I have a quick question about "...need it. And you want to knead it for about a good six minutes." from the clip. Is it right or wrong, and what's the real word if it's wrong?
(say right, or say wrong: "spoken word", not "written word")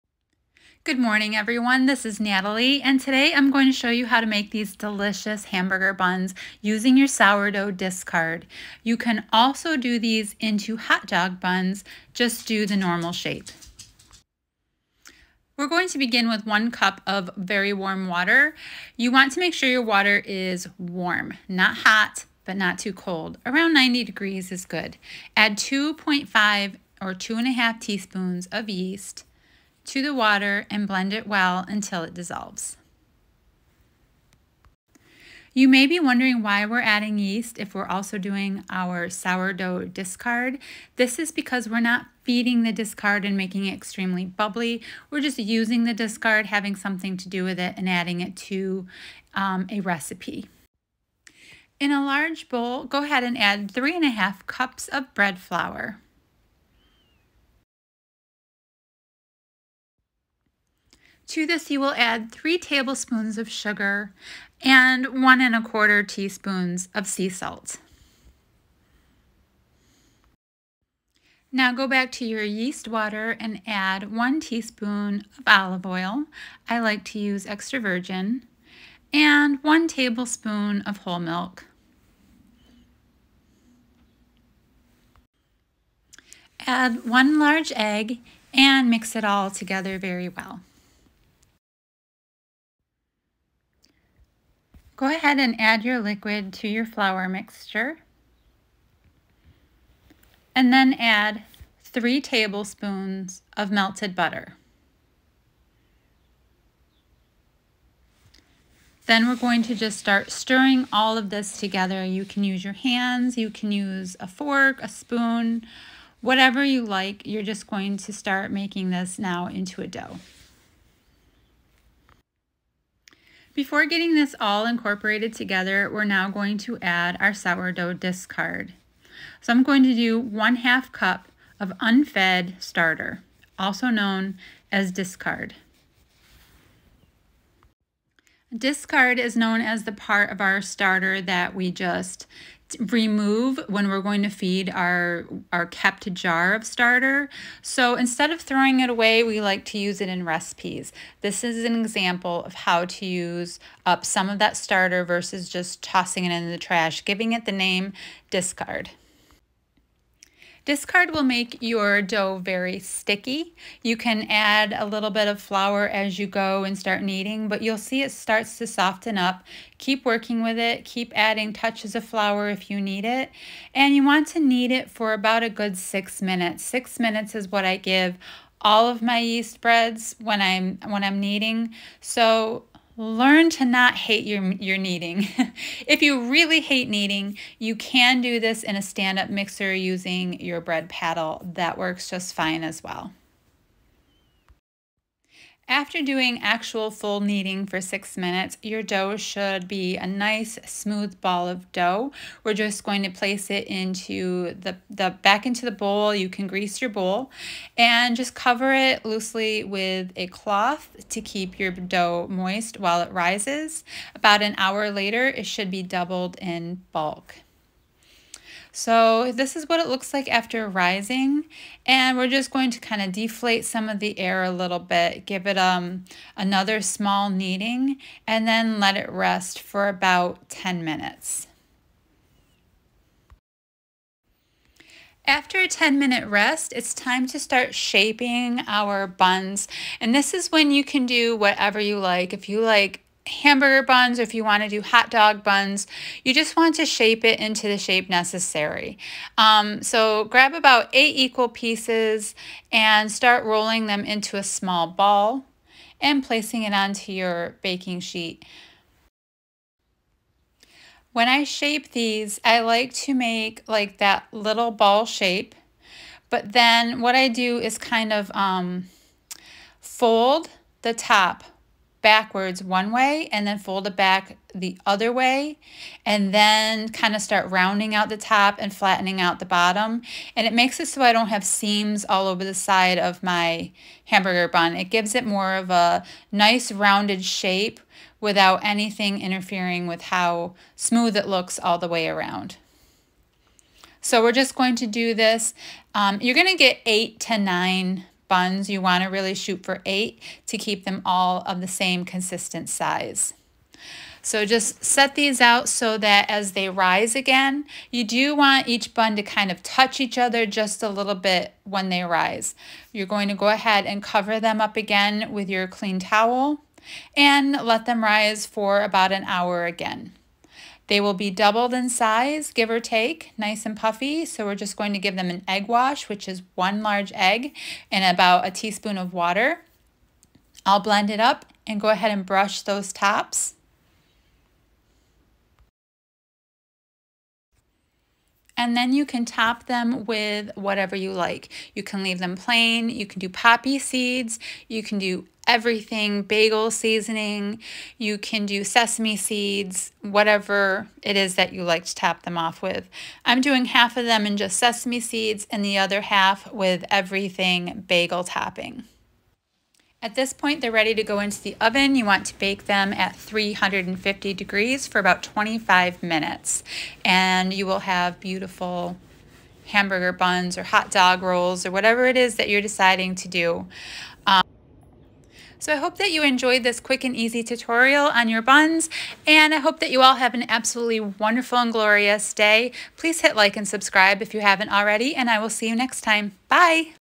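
right.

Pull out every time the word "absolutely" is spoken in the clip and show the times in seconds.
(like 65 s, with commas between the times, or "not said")
380 s.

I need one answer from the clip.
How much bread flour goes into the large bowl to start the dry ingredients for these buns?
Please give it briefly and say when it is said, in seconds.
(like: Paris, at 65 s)
3.5 cups, at 53 s.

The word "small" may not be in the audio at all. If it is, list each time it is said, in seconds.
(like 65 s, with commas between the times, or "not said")
226 s, 254 s.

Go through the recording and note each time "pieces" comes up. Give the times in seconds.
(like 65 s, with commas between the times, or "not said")
251 s.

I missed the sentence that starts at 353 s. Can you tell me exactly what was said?
I'm doing half of them in just sesame seeds and the other half with everything bagel topping.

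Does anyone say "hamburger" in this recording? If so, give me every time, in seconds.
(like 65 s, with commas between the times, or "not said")
5 s, 243 s, 284 s, 369 s.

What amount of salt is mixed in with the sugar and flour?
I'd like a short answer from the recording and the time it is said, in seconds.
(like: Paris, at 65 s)
1 1/4 teaspoons, at 65 s.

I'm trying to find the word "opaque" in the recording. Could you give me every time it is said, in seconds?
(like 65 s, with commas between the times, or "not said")
not said.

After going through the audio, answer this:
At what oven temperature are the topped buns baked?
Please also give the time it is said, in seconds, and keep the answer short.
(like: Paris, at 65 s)
350 degrees, at 363 s.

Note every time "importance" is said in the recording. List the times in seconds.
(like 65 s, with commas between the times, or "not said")
not said.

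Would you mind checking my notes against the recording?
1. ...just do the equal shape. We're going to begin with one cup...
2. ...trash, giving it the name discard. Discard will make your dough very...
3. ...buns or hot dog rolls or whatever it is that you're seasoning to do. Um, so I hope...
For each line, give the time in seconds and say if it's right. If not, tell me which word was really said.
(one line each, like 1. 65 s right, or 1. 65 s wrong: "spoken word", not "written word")
1. 12 s wrong: "normal", not "equal"
2. 156 s right
3. 370 s wrong: "deciding", not "seasoning".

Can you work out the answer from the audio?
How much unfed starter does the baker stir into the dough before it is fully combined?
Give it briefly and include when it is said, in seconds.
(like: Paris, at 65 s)
1/2 cup, at 130 s.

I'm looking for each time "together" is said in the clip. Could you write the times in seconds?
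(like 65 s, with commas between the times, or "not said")
89 s, 111 s, 125 s.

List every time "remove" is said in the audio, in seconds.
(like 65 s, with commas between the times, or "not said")
142 s.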